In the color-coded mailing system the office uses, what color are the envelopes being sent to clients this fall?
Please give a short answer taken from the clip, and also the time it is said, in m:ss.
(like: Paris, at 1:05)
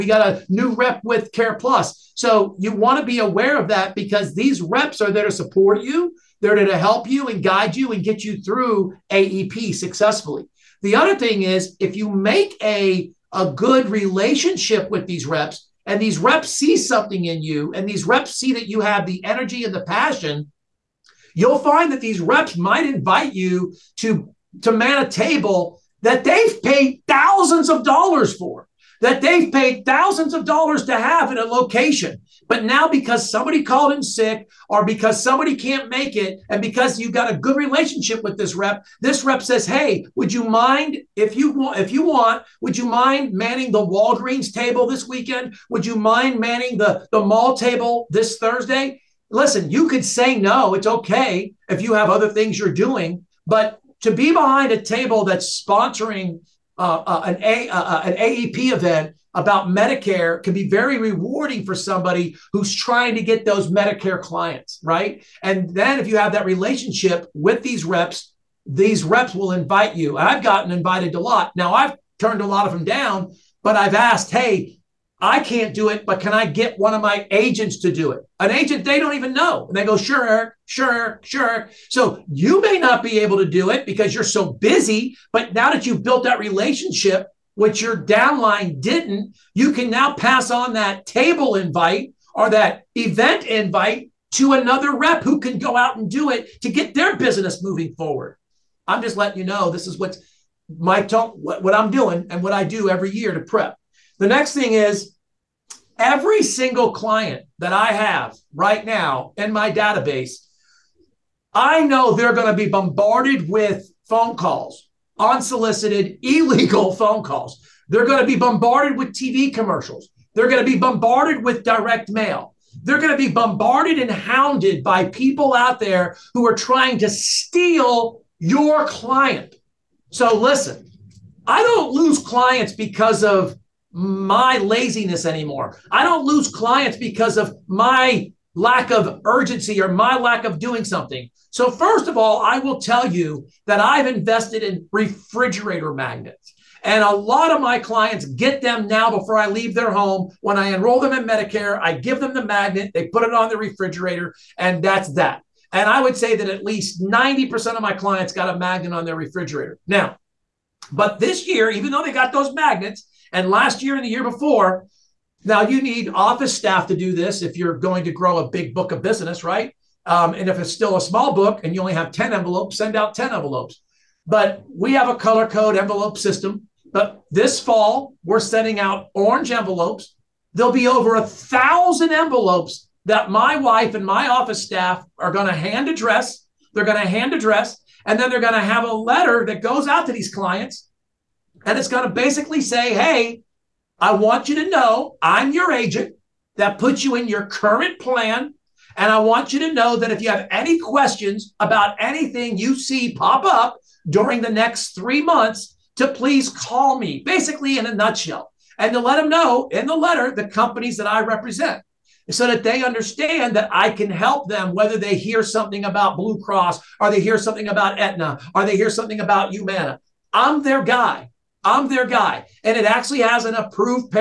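Orange, at 2:59.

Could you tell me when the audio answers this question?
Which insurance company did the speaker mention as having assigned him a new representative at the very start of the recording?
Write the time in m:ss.
0:01.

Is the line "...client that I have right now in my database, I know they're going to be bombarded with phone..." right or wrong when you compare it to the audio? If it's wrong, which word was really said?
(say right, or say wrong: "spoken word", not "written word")
right.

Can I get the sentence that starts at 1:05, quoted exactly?
And then if you have that relationship with these reps, these reps will invite you.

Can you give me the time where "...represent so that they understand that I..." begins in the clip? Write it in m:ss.
3:31.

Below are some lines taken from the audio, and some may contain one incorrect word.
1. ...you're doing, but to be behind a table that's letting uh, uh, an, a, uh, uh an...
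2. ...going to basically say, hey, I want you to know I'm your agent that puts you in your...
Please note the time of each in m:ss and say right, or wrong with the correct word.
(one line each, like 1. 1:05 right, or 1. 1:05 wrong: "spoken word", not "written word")
1. 0:52 wrong: "sponsoring", not "letting"
2. 3:11 right.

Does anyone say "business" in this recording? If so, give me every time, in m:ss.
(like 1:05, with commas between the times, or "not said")
1:37, 2:49.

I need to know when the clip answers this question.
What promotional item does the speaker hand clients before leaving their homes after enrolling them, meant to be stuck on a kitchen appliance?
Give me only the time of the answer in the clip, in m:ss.
2:24.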